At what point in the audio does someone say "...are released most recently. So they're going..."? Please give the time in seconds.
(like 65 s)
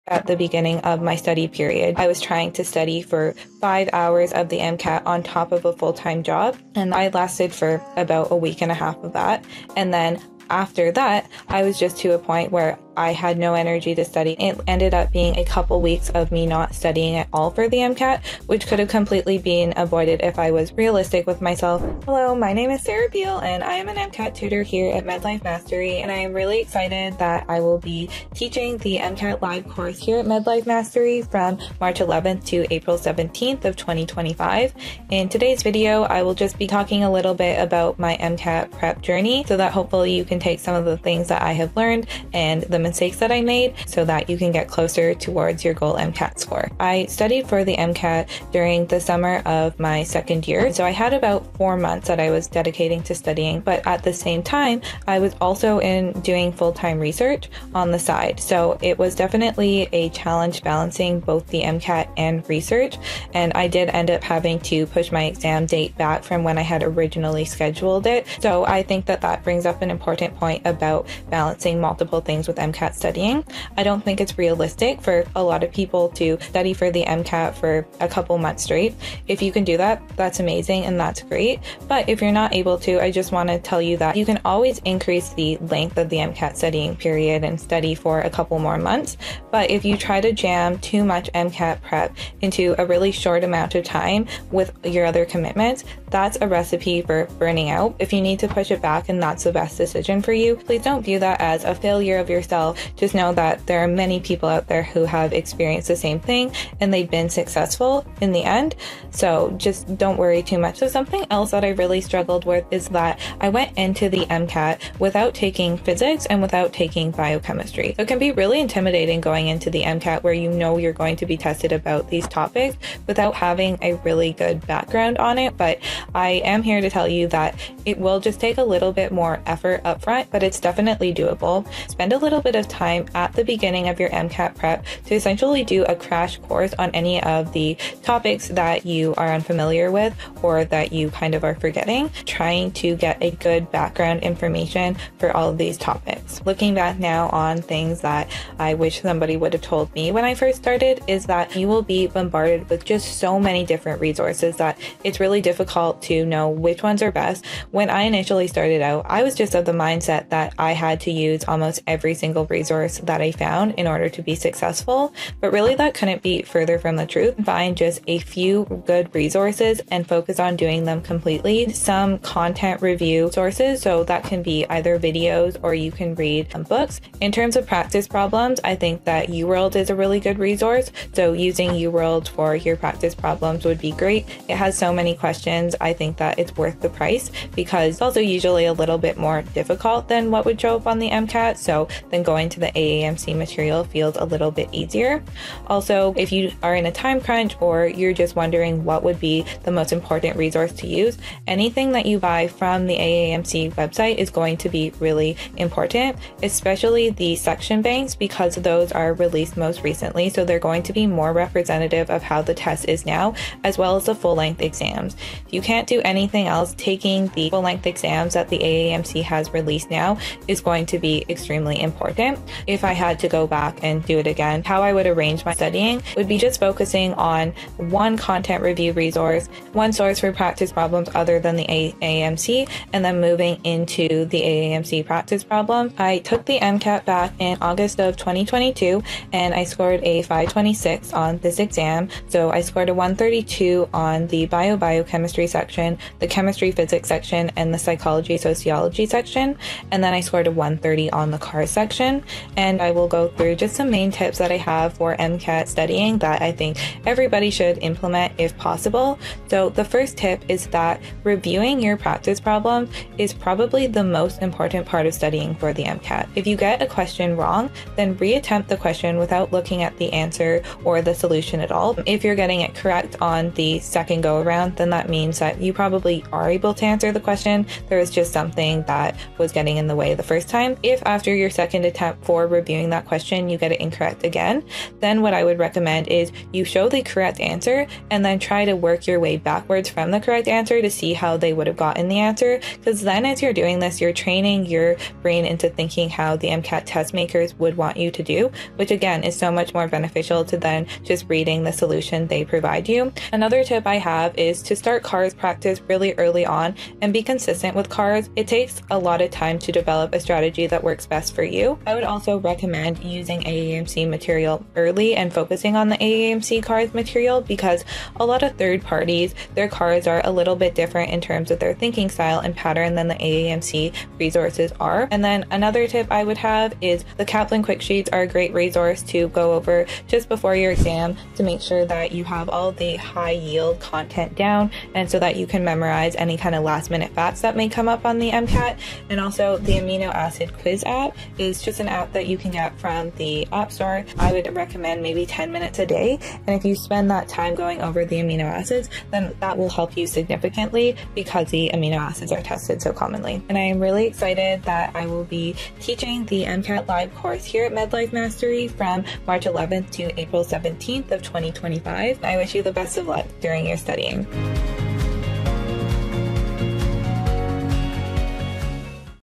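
208 s.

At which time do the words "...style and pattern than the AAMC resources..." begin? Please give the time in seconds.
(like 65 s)
322 s.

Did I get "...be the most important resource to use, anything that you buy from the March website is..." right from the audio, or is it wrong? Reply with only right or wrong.
wrong.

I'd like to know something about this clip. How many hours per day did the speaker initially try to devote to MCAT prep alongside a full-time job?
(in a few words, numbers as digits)
5.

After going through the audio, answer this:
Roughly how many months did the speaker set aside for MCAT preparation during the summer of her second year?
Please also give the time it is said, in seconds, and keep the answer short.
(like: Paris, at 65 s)
4 months, at 51 s.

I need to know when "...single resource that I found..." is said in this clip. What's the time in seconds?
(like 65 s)
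162 s.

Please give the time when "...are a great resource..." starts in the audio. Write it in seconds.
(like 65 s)
328 s.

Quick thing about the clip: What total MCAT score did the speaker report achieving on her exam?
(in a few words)
526.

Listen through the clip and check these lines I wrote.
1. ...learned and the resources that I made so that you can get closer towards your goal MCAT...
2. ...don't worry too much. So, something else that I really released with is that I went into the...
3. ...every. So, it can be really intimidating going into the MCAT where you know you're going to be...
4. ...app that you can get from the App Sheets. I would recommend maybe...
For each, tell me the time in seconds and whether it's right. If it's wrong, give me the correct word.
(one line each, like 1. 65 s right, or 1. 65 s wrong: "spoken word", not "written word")
1. 41 s wrong: "mistakes", not "resources"
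2. 109 s wrong: "struggled", not "released"
3. 117 s wrong: "biochemistry", not "every"
4. 341 s wrong: "Store", not "Sheets".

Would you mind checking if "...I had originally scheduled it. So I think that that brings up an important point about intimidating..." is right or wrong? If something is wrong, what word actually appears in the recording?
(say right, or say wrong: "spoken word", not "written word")
wrong: "balancing", not "intimidating".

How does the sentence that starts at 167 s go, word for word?
Find just a few good resources and focus on doing them completely.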